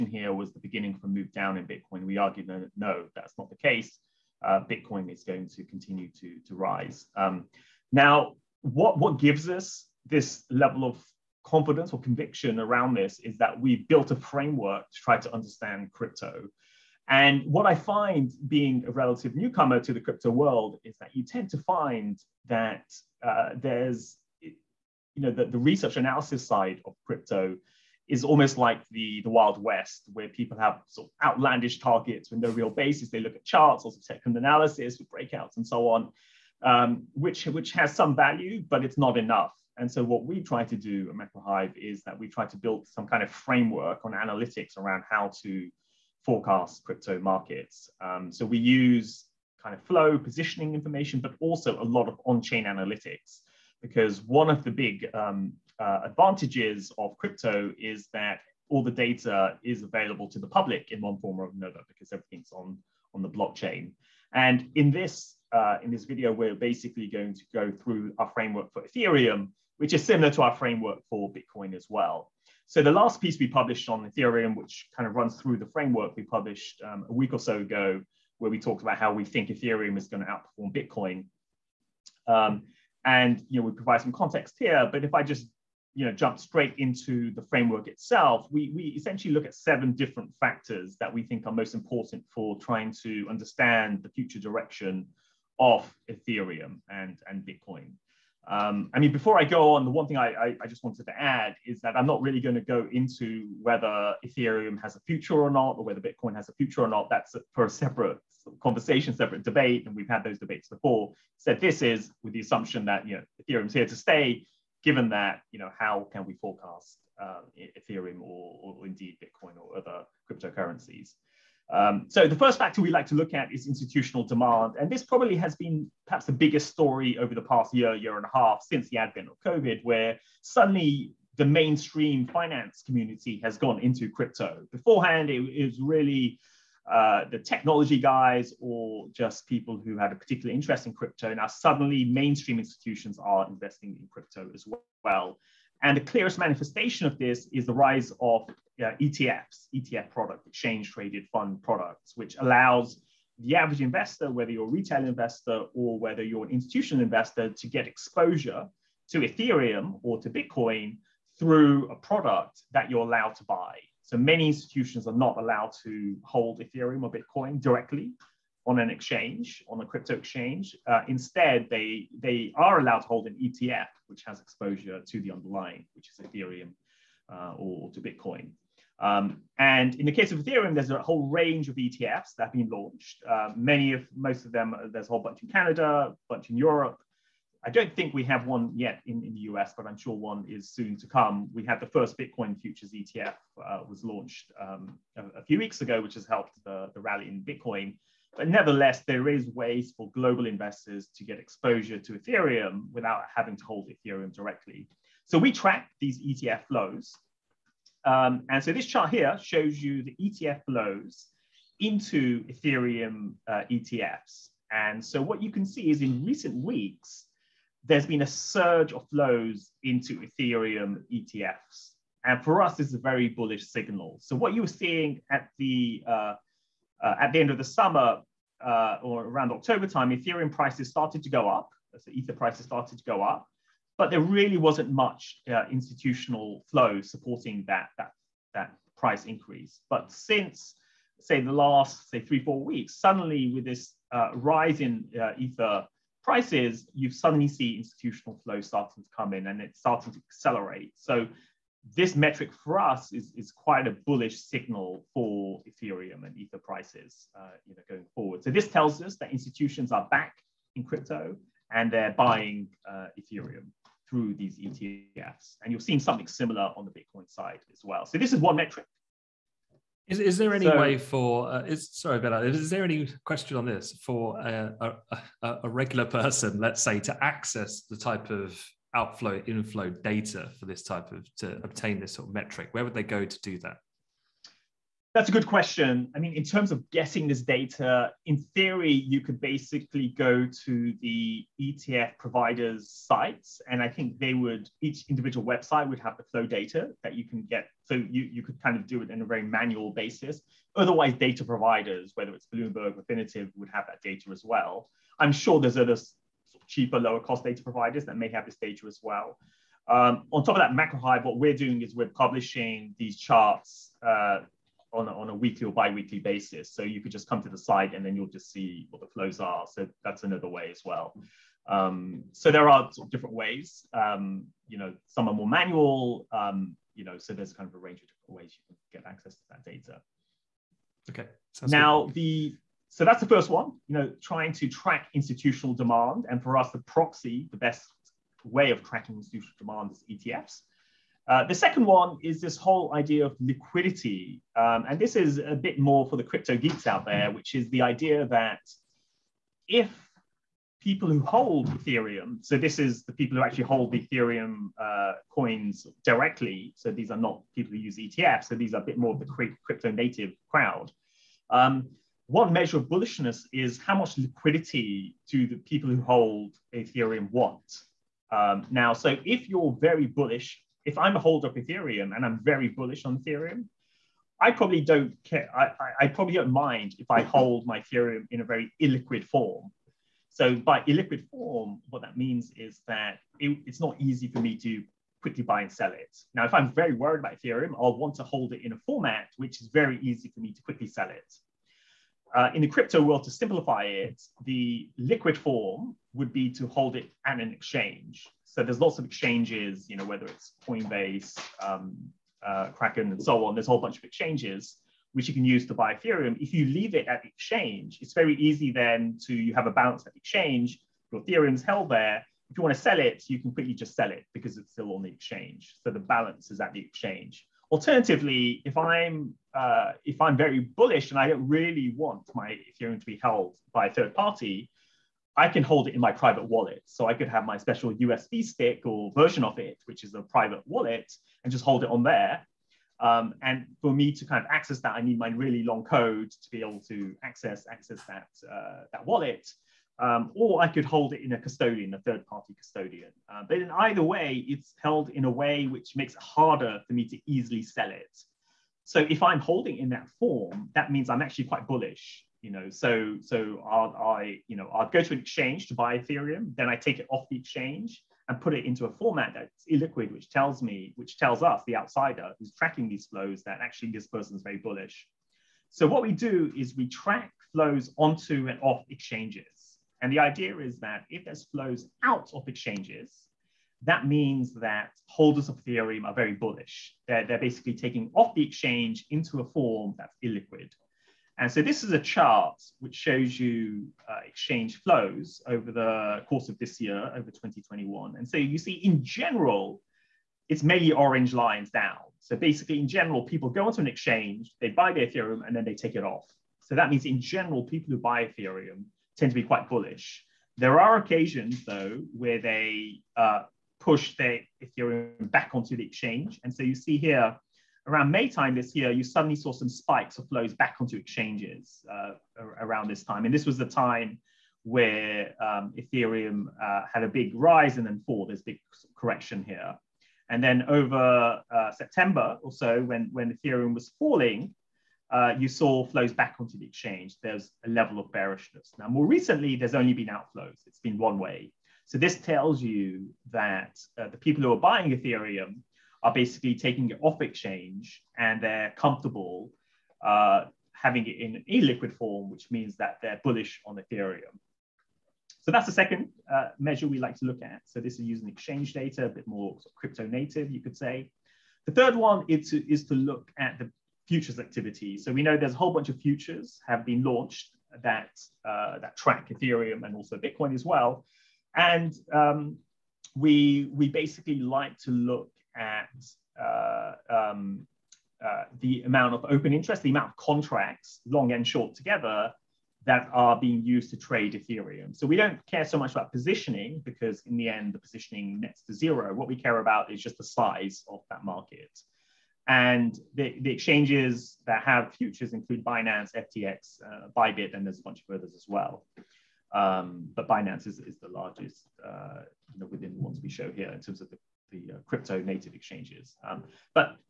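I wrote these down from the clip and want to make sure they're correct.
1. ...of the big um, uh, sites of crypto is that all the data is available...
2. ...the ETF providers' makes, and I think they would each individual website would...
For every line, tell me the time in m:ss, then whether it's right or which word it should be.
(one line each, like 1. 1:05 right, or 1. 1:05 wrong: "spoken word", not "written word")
1. 0:54 wrong: "advantages", not "sites"
2. 4:51 wrong: "sites", not "makes".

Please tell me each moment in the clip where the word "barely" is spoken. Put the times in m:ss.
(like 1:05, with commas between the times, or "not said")
not said.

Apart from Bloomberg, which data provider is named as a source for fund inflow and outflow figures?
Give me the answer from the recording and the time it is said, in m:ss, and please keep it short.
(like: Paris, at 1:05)
Refinitiv, at 5:02.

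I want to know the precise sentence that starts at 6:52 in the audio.
If you want to sell it, you can quickly just sell it because it's still on the exchange.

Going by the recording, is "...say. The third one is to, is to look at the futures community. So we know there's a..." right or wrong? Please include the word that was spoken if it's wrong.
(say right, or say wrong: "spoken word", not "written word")
wrong: "activity", not "community".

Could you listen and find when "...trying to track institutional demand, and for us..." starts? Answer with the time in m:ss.
5:34.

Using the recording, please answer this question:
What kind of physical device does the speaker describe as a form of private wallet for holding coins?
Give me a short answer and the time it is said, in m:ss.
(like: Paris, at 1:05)
USB stick, at 7:07.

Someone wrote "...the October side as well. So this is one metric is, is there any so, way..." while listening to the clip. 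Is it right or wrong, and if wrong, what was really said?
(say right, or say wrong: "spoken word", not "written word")
wrong: "Bitcoin", not "October".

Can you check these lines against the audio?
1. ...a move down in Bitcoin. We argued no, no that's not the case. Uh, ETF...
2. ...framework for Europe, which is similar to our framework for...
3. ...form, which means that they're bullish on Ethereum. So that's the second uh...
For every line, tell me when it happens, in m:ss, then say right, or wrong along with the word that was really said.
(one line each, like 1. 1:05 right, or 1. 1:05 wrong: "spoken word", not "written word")
1. 0:01 wrong: "Bitcoin", not "ETF"
2. 1:08 wrong: "Ethereum", not "Europe"
3. 9:01 right.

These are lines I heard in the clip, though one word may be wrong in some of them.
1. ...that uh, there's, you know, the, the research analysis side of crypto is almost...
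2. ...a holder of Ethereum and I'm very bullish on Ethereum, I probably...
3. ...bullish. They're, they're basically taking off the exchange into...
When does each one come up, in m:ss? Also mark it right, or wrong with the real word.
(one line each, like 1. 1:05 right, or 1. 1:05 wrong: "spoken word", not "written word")
1. 0:22 right
2. 6:11 right
3. 7:56 right.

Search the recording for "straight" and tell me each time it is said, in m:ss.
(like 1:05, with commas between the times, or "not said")
1:26.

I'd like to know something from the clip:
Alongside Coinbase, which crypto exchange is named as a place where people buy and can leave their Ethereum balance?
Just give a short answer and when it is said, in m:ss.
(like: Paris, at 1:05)
Kraken, at 6:42.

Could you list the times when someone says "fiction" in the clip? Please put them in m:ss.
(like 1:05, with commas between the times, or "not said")
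not said.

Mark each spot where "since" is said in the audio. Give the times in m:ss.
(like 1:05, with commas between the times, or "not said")
2:08, 4:00.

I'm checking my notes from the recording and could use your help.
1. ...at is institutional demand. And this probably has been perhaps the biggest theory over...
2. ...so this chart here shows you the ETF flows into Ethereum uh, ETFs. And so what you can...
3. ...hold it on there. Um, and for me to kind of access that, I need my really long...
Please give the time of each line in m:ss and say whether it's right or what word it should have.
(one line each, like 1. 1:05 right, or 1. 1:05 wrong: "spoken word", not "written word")
1. 2:03 wrong: "story", not "theory"
2. 3:28 right
3. 7:11 right.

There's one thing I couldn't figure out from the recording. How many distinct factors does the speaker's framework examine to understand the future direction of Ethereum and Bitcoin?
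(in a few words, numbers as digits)
7.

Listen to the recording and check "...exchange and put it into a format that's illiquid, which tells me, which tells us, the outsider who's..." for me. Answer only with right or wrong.
right.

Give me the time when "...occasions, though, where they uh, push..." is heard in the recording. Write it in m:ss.
8:20.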